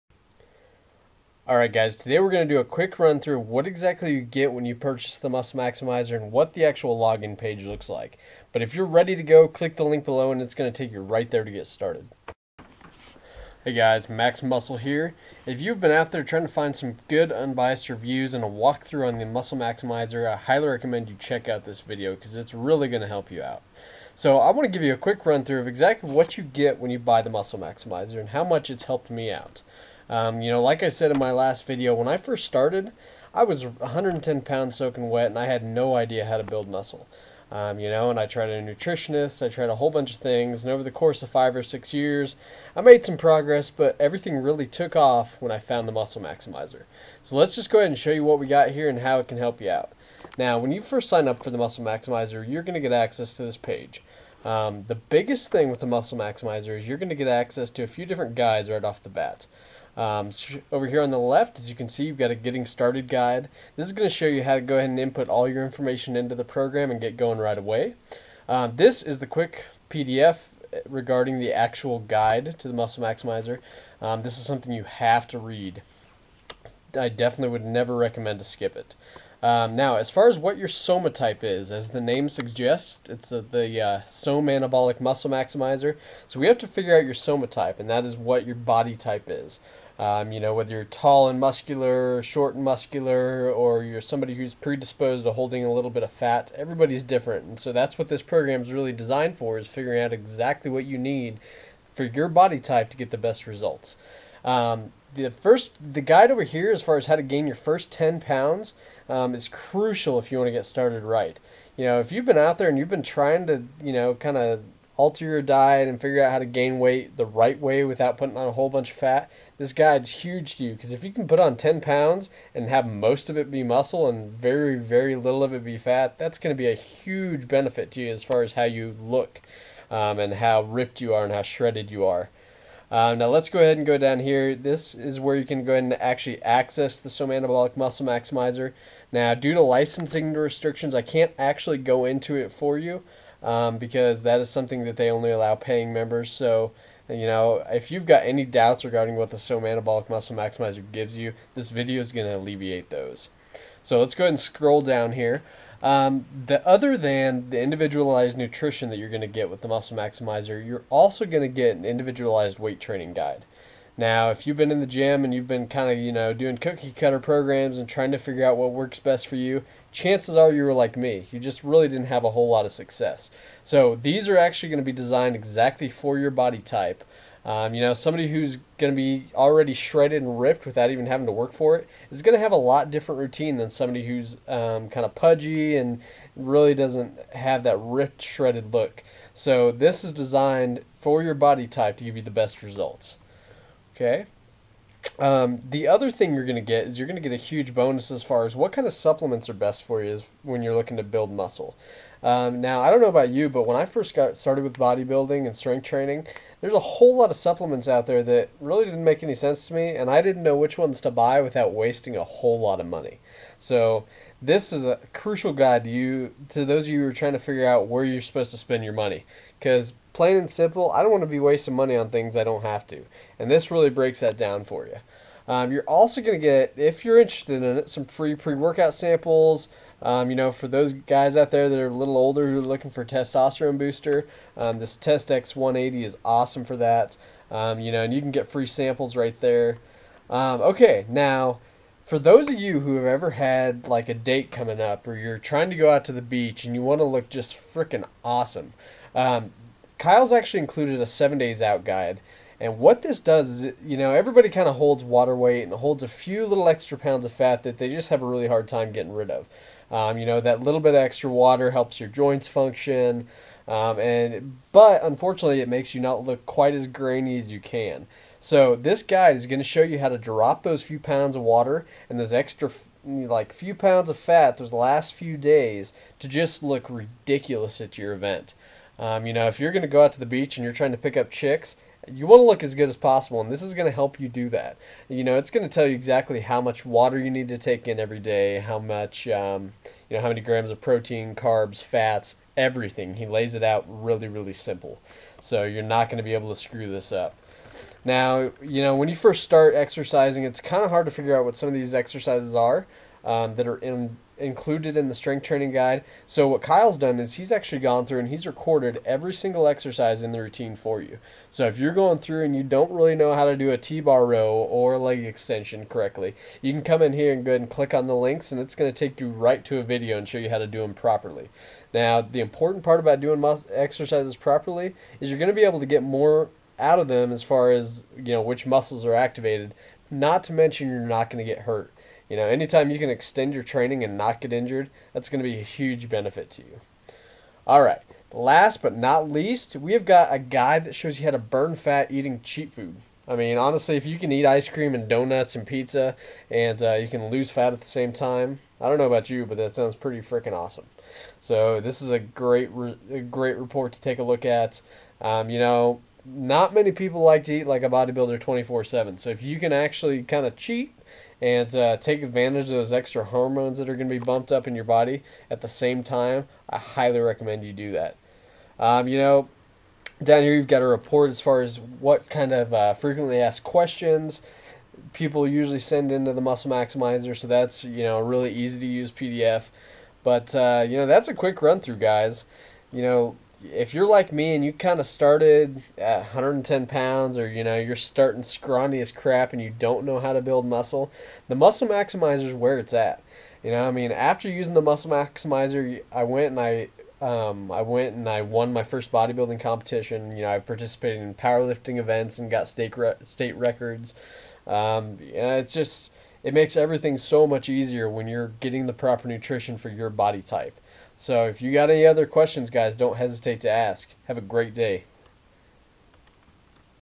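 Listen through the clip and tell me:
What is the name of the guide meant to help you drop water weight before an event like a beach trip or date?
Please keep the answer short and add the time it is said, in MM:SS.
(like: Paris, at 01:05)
seven days out guide, at 04:11.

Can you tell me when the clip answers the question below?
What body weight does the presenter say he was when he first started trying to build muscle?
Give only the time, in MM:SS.
00:33.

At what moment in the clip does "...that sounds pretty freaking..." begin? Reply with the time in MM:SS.
05:49.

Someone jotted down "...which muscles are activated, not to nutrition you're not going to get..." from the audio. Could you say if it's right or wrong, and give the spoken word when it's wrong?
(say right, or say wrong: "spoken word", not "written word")
wrong: "mention", not "nutrition".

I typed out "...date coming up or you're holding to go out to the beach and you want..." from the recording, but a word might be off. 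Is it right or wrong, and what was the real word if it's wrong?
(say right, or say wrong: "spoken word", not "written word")
wrong: "trying", not "holding".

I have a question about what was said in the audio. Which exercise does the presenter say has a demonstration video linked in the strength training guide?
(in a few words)
T-bar row.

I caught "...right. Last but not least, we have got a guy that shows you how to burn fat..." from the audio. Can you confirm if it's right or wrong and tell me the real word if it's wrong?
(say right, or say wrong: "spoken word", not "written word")
right.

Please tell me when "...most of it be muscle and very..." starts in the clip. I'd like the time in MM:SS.
02:02.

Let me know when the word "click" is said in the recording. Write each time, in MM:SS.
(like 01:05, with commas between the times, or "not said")
00:09, 05:17.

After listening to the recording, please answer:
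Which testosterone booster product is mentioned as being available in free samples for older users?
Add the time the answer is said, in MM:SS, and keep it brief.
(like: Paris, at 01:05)
Test X 180, at 03:54.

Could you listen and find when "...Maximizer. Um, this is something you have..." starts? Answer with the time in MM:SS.
01:13.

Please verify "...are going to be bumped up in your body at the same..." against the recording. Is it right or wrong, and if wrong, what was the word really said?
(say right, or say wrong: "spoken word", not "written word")
right.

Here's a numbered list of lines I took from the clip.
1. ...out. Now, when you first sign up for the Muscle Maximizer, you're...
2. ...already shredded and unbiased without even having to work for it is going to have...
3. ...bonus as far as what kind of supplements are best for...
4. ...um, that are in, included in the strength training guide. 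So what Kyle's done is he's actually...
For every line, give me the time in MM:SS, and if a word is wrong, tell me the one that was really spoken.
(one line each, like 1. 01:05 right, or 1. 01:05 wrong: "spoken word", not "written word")
1. 00:49 right
2. 02:59 wrong: "ripped", not "unbiased"
3. 03:17 right
4. 05:03 right.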